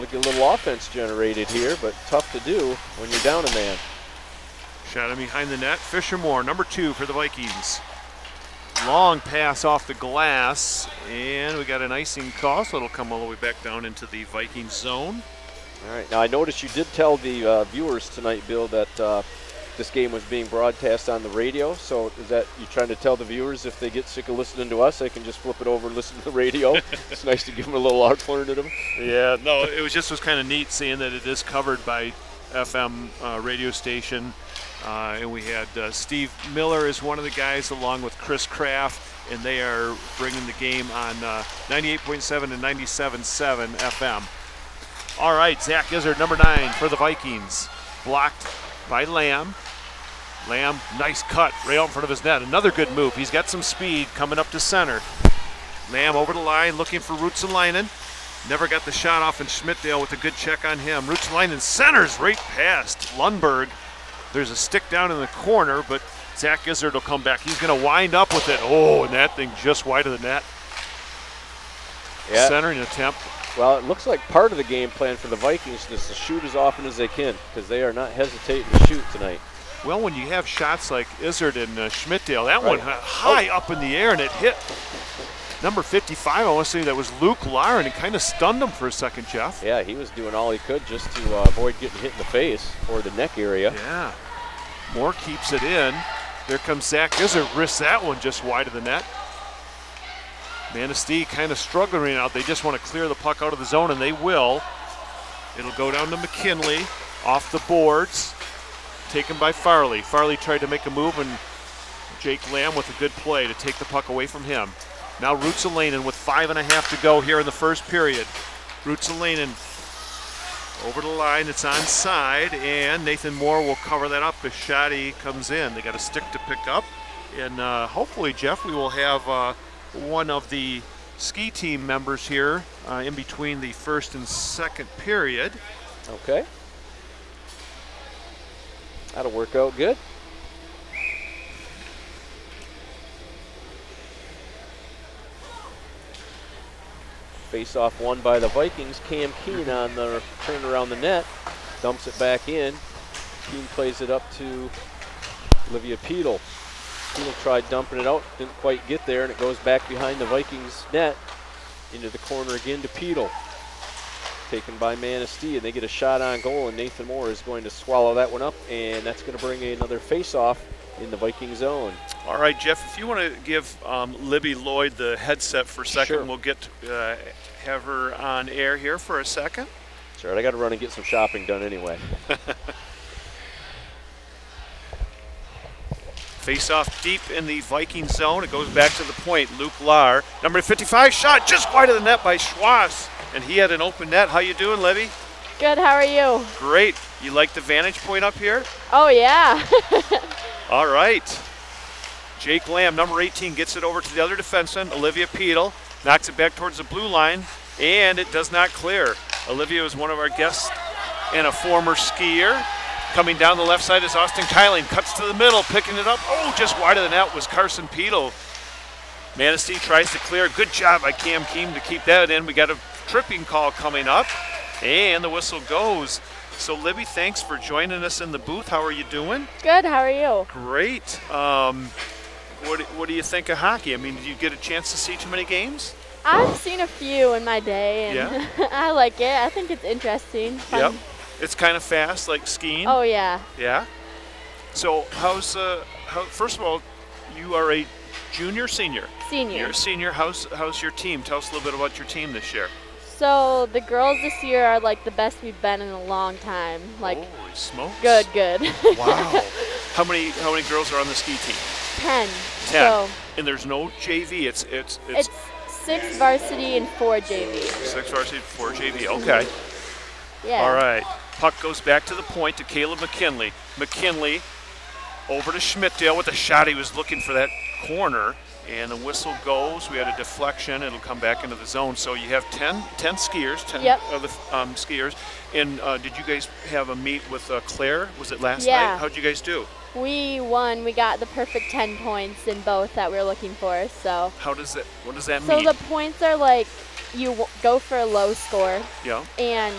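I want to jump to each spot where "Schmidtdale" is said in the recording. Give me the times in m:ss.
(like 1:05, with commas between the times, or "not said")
0:59, 1:21, 4:35.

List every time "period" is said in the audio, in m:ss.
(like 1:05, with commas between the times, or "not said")
1:57, 2:14.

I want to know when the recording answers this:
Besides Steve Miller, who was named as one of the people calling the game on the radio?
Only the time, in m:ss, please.
0:38.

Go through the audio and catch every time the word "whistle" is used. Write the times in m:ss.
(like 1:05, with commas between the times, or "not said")
3:45, 4:38.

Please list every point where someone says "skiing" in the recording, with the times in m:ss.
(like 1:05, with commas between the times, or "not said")
4:02.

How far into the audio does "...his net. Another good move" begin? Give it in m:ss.
0:52.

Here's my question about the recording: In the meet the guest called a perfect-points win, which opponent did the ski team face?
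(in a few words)
Claire.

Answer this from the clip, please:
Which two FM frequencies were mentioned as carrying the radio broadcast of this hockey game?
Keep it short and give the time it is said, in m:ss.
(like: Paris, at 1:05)
98.7 and 97.7, at 0:41.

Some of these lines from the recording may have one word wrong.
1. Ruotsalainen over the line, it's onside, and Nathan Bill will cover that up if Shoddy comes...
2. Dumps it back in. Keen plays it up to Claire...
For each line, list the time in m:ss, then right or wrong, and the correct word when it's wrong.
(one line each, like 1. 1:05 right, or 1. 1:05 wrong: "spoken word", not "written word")
1. 1:58 wrong: "Moore", not "Bill"
2. 2:31 wrong: "Olivia", not "Claire".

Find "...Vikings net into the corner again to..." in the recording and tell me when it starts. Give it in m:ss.
2:40.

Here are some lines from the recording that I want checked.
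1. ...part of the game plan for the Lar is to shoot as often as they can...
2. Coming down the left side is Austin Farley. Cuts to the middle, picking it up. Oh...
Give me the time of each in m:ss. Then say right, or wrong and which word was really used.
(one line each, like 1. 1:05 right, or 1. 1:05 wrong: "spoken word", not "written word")
1. 1:14 wrong: "Vikings", not "Lar"
2. 3:33 wrong: "Kyling", not "Farley".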